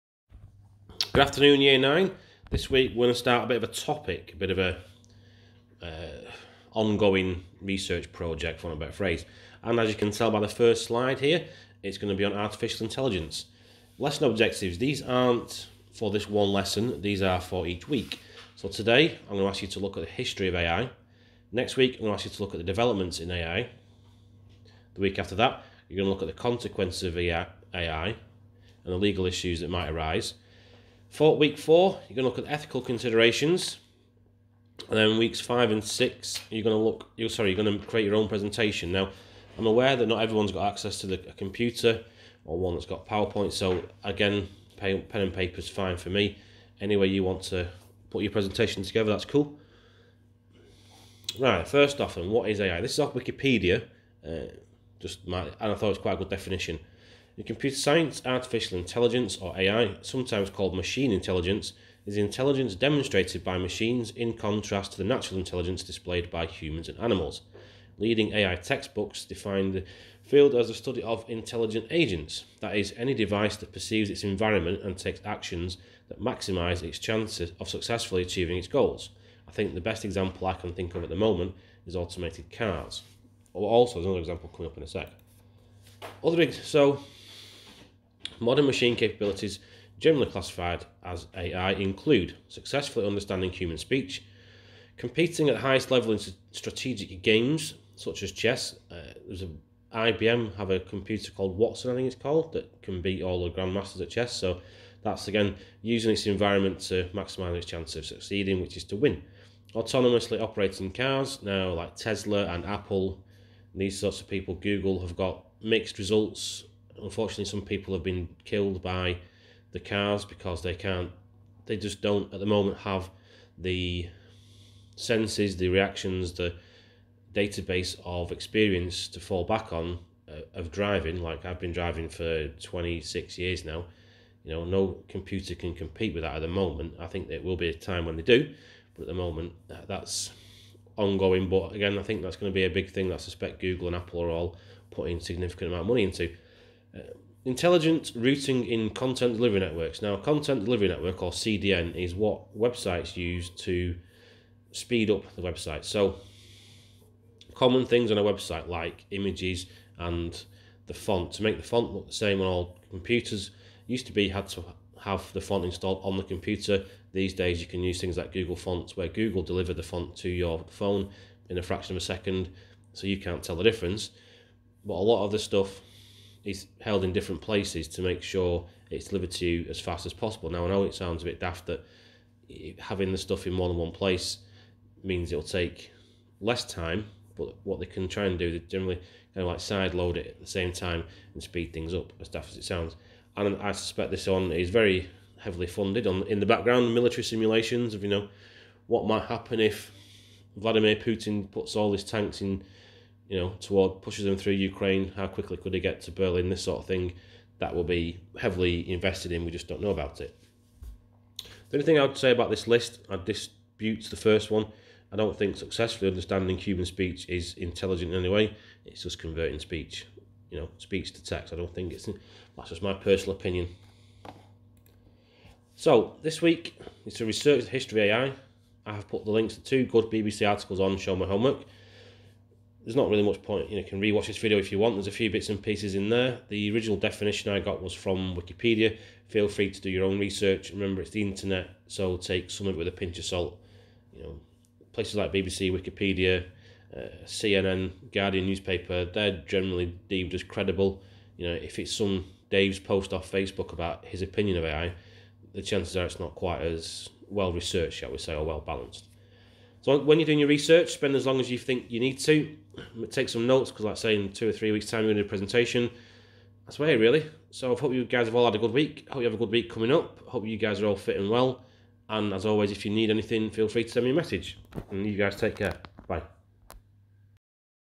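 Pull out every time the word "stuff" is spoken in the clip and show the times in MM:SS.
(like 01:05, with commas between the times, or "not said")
02:55, 03:03.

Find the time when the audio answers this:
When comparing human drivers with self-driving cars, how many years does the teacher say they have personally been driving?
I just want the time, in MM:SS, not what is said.
02:12.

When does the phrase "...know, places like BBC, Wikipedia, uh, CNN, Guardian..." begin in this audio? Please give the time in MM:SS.
04:04.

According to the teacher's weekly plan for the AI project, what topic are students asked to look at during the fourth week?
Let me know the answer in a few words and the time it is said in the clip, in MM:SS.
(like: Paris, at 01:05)
Ethical considerations, at 00:32.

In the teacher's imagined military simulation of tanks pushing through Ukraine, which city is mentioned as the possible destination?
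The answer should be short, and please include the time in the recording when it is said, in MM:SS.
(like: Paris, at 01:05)
Berlin, at 03:26.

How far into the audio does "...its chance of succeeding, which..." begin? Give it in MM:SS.
01:47.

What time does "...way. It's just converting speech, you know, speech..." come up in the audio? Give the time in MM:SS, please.
03:38.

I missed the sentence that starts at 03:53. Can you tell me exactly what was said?
You know, you can rewatch this video if you want.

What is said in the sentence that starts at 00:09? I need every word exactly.
And as you can tell by the first slide here, it's going to be on artificial intelligence.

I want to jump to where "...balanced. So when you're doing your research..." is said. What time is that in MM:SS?
04:18.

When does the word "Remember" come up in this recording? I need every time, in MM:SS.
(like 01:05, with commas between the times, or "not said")
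04:00.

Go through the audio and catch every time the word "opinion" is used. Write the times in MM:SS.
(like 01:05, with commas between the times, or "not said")
03:43, 04:14.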